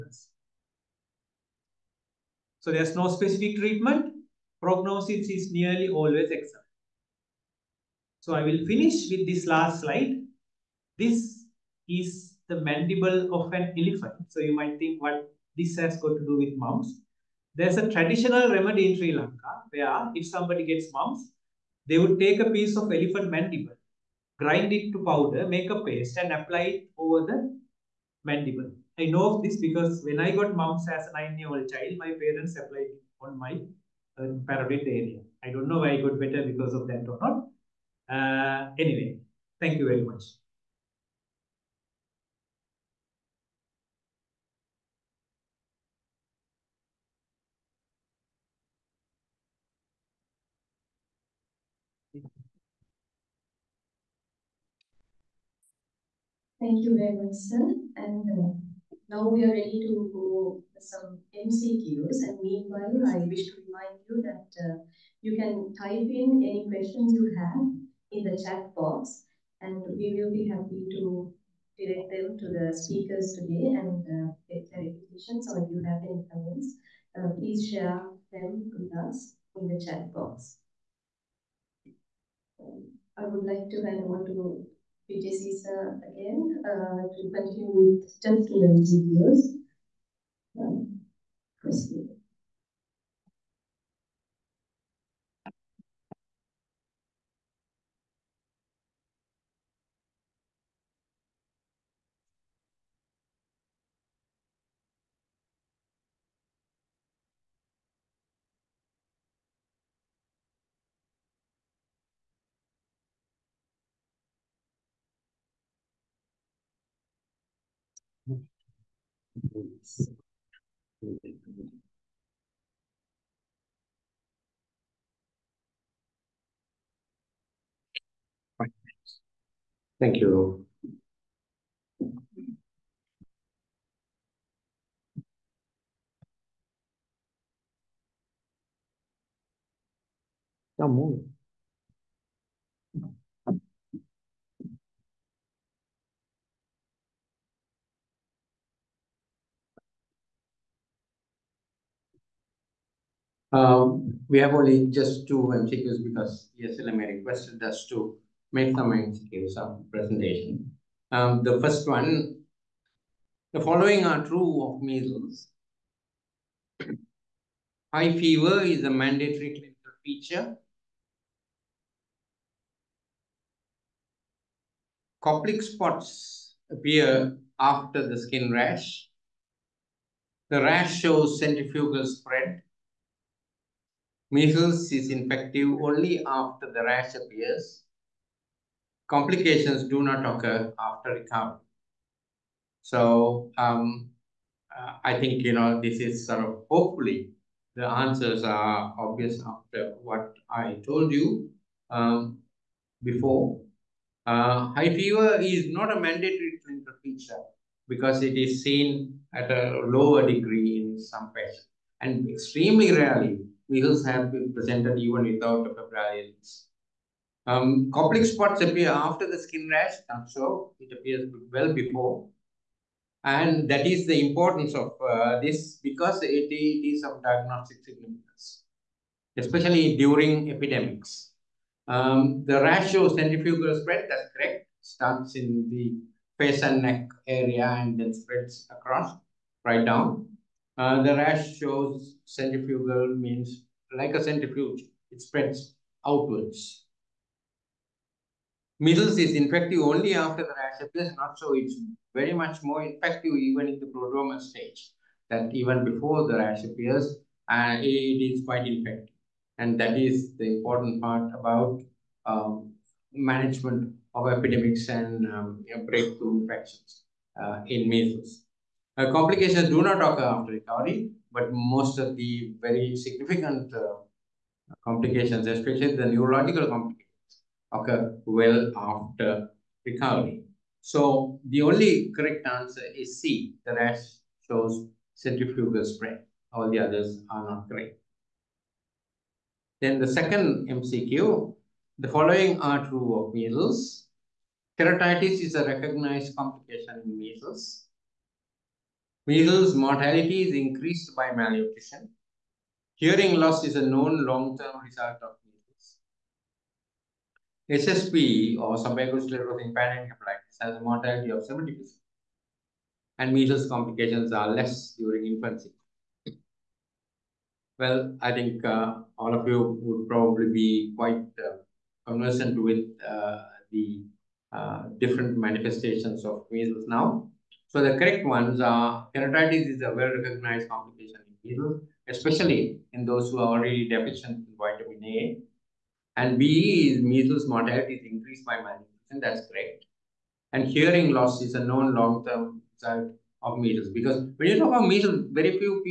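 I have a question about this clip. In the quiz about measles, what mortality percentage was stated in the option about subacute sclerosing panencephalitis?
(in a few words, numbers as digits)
70%.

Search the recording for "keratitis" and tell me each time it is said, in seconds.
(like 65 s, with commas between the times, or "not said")
294 s, 329 s.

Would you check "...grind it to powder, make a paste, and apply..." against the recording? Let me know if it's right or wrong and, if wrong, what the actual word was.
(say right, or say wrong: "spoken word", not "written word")
right.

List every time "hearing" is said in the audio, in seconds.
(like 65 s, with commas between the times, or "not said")
302 s, 340 s.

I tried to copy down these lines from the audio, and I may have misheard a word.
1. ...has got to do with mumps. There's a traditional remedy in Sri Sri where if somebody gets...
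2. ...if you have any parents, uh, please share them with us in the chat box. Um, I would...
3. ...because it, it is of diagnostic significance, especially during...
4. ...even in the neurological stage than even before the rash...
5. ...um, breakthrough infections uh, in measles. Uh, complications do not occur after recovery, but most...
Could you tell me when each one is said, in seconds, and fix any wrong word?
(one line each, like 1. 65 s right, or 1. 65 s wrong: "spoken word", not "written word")
1. 15 s wrong: "Lanka", not "Sri"
2. 75 s wrong: "comments", not "parents"
3. 225 s right
4. 253 s wrong: "prodromal", not "neurological"
5. 265 s right.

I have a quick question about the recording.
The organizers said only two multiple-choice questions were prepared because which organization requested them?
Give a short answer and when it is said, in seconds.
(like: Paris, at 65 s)
ESLM, at 156 s.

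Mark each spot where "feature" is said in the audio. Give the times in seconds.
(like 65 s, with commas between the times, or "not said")
170 s, 207 s.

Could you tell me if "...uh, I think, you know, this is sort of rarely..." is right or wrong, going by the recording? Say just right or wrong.
wrong.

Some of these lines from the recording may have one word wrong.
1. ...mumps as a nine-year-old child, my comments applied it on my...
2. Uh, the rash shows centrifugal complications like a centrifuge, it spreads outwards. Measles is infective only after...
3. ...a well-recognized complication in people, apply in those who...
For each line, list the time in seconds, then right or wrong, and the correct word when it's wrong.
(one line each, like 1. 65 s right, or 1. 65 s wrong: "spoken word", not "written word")
1. 30 s wrong: "parents", not "comments"
2. 240 s wrong: "means", not "complications"
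3. 329 s wrong: "especially", not "apply".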